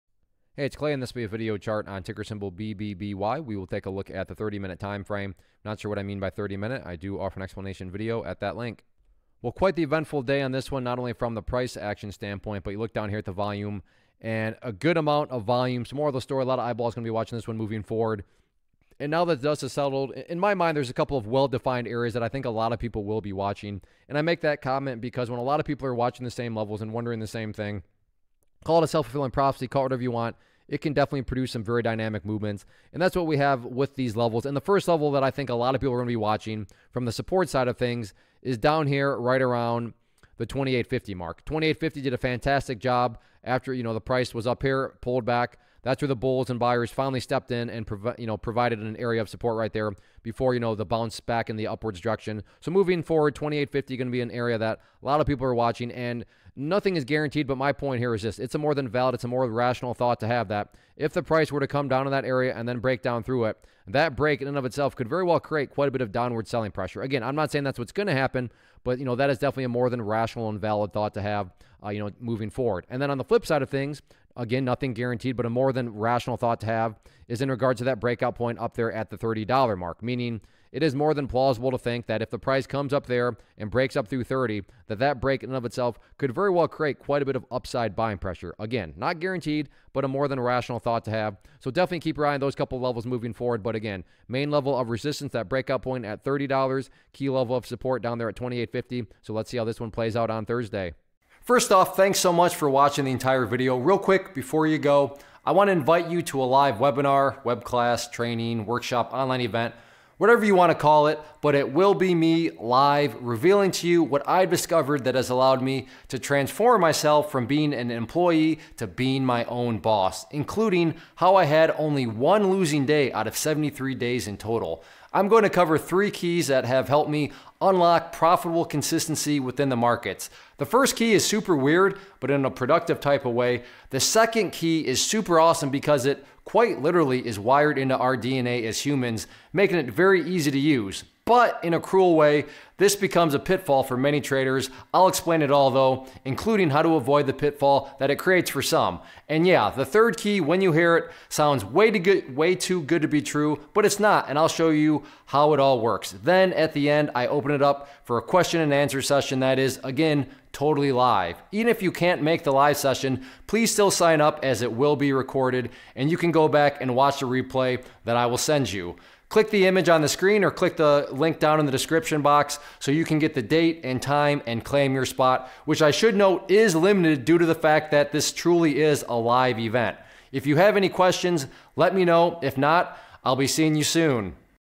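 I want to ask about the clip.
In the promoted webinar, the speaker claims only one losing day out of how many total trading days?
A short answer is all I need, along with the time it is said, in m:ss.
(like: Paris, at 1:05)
73, at 2:03.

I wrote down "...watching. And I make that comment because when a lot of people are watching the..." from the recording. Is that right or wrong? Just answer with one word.
right.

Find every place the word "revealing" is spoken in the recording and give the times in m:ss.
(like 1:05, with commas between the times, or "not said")
1:53.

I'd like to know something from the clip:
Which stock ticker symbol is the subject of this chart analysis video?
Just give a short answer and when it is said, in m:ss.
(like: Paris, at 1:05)
BBBY, at 0:02.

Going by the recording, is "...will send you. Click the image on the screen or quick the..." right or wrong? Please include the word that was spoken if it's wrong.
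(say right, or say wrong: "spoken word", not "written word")
wrong: "click", not "quick".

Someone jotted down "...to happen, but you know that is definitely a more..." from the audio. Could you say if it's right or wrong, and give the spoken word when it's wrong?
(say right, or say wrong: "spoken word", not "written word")
right.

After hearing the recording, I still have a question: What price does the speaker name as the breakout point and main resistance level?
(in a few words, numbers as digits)
$30.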